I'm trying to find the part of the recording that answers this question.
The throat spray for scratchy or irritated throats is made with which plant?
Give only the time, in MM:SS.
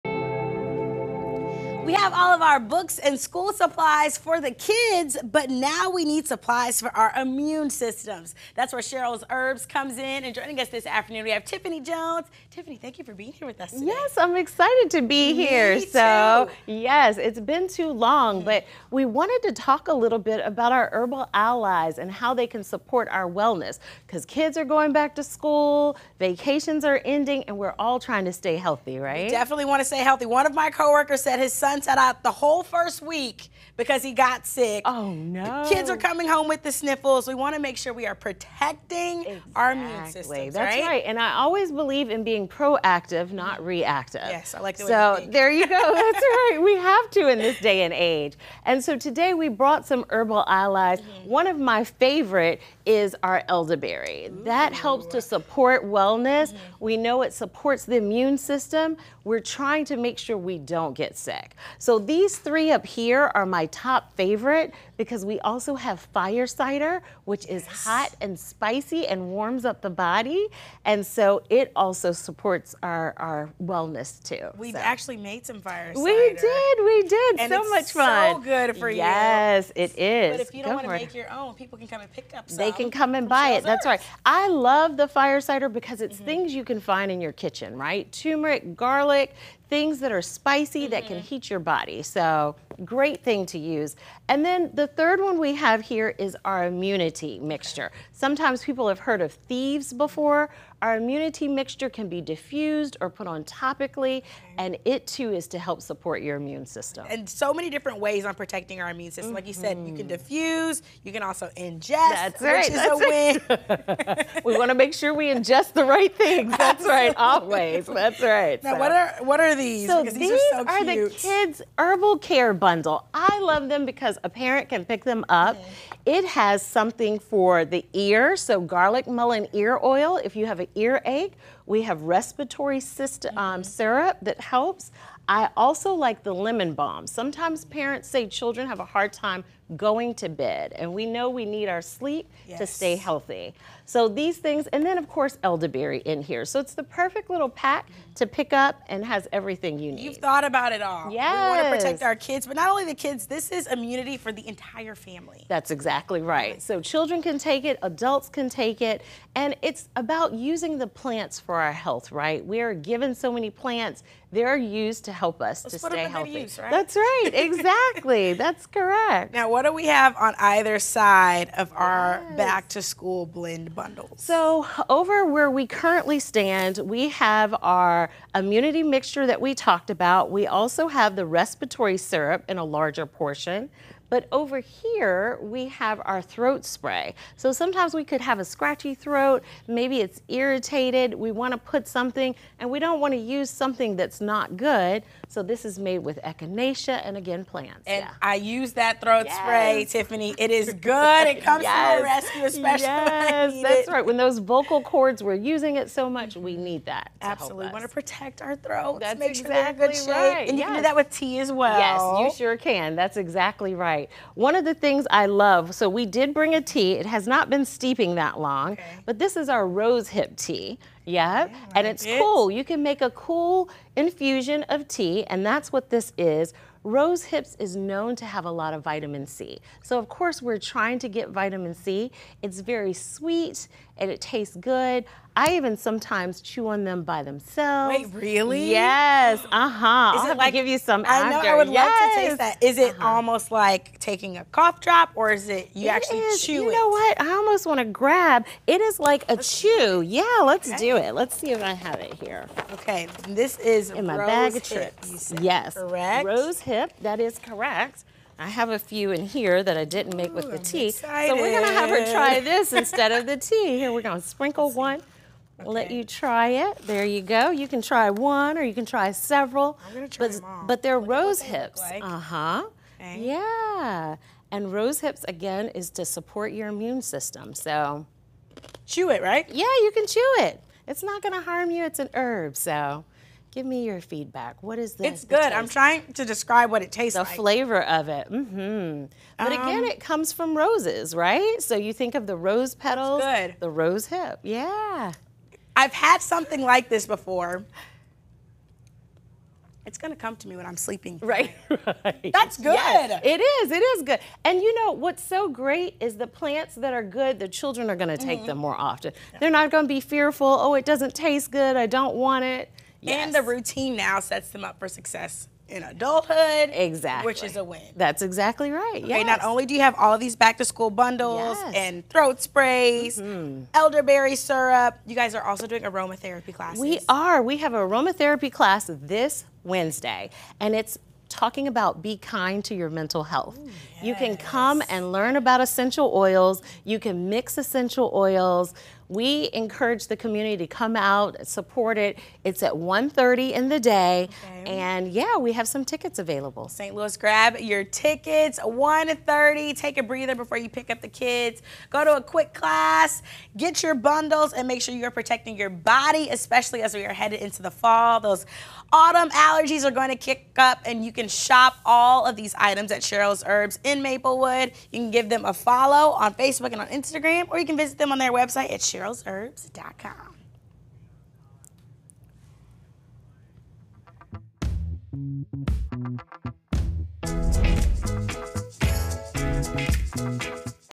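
03:16.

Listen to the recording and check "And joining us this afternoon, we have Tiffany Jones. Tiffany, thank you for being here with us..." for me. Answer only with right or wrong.
right.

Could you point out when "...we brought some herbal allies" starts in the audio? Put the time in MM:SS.
00:49.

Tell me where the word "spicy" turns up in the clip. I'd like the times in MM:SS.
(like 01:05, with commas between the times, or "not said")
01:08, 01:30.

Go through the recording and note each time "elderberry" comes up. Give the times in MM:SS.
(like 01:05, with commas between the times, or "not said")
00:53, 02:25, 05:23.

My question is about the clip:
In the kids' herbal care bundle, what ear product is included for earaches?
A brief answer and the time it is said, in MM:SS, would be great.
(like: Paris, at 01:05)
Garlic mullein ear oil, at 02:08.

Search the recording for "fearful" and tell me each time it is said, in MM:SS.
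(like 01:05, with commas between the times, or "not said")
05:10.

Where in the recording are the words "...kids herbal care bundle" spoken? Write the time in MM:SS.
02:01.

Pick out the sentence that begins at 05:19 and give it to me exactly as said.
not only do you have all these back to school bundles yes.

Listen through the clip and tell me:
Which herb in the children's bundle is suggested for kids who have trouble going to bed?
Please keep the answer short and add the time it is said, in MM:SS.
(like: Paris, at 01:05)
Lemon balm, at 02:16.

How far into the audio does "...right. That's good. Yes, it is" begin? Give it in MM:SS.
05:02.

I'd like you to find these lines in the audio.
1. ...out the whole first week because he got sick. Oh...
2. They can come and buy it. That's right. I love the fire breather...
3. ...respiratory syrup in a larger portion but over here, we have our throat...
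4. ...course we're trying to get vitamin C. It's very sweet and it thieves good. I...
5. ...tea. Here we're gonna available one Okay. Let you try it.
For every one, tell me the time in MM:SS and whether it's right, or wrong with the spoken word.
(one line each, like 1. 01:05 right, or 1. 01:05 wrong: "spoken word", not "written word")
1. 00:32 right
2. 01:22 wrong: "cider", not "breather"
3. 03:01 right
4. 03:50 wrong: "tastes", not "thieves"
5. 04:23 wrong: "sprinkle", not "available".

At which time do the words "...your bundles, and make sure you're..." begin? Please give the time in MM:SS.
05:53.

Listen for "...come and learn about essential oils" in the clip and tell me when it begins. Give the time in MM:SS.
05:34.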